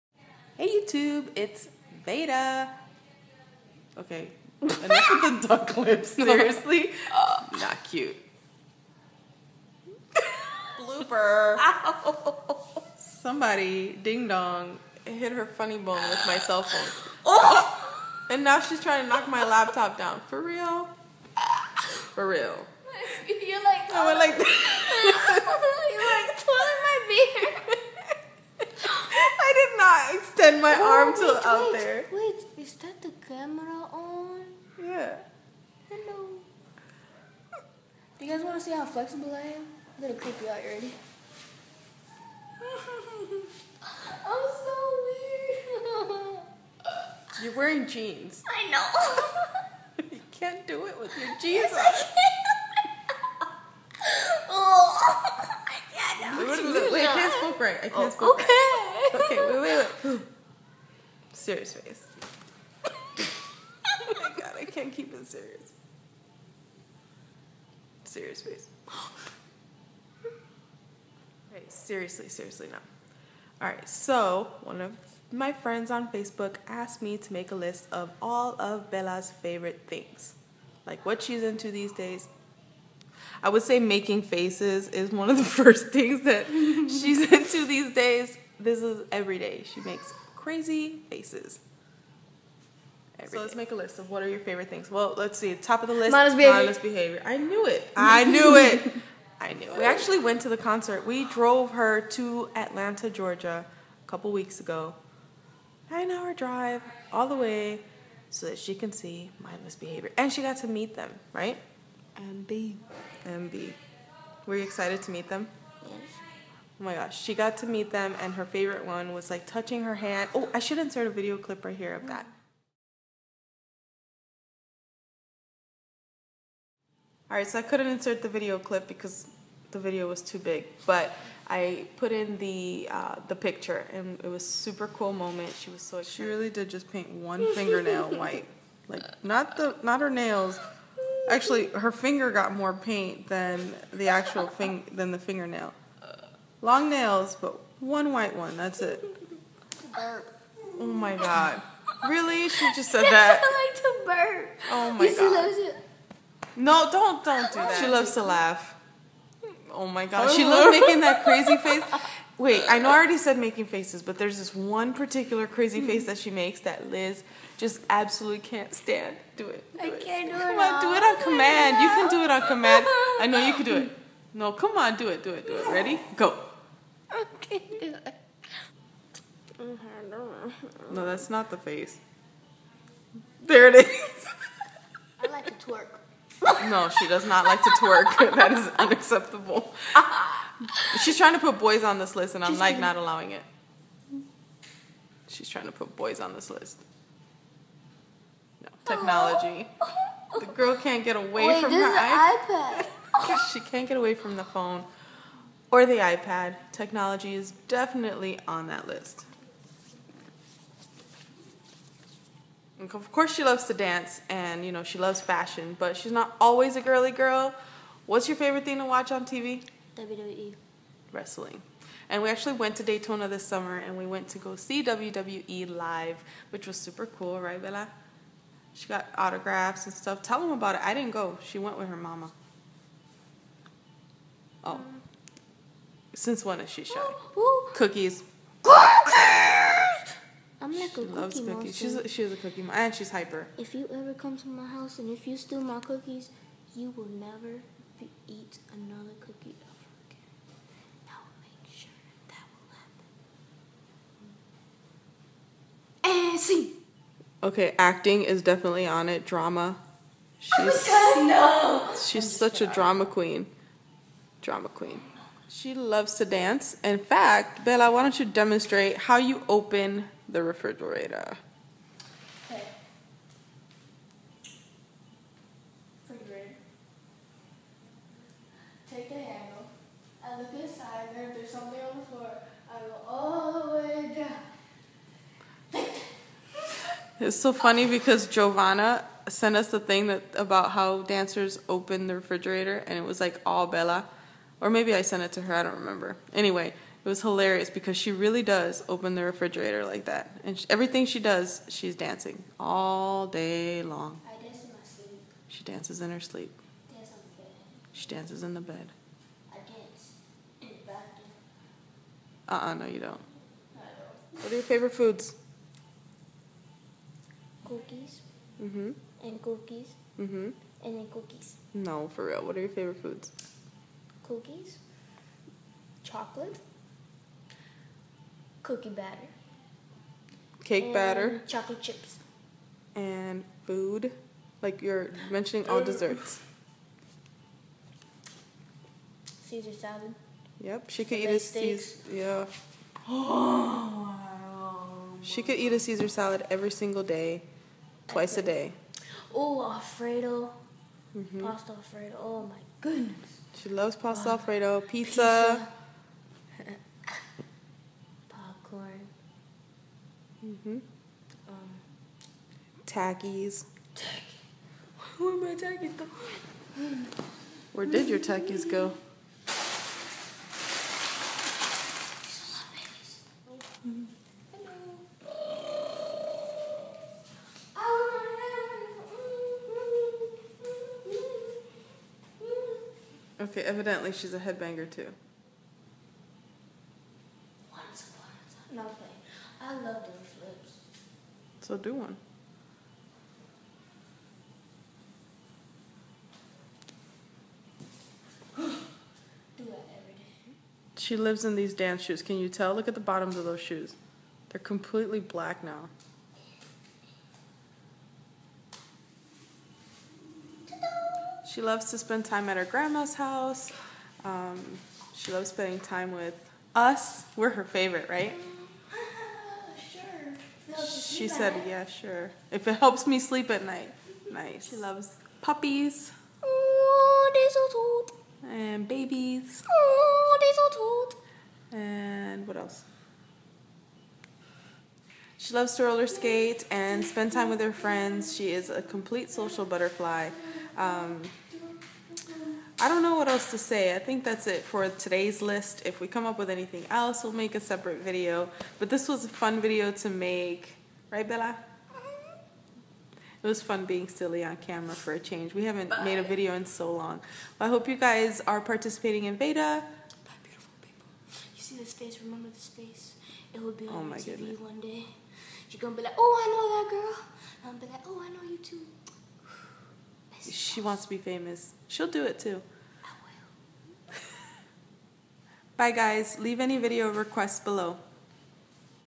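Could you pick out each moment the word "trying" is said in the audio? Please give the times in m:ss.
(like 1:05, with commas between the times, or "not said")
0:18, 3:11, 3:15.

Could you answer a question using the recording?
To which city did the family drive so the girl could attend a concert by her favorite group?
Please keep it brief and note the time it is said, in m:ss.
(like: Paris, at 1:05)
Atlanta, Georgia, at 1:42.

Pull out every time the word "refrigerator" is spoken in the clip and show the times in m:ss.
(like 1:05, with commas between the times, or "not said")
4:30, 4:52, 4:59.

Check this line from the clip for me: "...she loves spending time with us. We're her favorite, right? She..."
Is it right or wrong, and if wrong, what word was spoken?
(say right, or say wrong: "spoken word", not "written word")
right.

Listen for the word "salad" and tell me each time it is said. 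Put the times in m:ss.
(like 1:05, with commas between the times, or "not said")
5:39, 5:46.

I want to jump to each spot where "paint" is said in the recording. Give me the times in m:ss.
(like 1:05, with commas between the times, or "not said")
2:16, 2:22.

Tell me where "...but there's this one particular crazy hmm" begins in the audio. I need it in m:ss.
2:44.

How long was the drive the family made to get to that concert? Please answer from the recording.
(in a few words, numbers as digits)
9 hours.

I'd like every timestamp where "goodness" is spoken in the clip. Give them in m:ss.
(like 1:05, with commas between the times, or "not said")
5:52, 7:44.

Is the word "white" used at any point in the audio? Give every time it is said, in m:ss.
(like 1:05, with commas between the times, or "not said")
2:18, 2:28.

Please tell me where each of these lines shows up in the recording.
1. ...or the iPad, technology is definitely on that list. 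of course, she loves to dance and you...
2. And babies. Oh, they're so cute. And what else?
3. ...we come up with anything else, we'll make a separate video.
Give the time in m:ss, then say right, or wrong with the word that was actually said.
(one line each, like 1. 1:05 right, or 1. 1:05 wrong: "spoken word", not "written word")
1. 3:25 right
2. 7:08 right
3. 7:26 right.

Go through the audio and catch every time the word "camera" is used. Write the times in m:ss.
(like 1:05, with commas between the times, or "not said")
0:33, 7:34.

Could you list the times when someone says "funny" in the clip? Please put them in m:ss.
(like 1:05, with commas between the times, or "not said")
0:15, 4:47.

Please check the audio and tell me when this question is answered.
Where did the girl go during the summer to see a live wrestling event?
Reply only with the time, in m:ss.
3:42.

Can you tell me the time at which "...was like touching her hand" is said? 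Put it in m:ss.
1:59.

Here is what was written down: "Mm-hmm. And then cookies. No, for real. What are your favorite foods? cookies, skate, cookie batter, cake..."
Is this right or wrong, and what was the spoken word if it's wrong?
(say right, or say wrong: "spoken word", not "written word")
wrong: "chocolate", not "skate".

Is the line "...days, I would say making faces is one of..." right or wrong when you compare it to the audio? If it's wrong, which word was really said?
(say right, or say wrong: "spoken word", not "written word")
right.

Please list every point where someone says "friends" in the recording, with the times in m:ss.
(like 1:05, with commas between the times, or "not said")
1:15, 7:17.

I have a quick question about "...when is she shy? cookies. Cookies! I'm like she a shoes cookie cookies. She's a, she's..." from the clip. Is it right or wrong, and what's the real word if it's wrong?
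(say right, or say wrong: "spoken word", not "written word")
wrong: "loves", not "shoes".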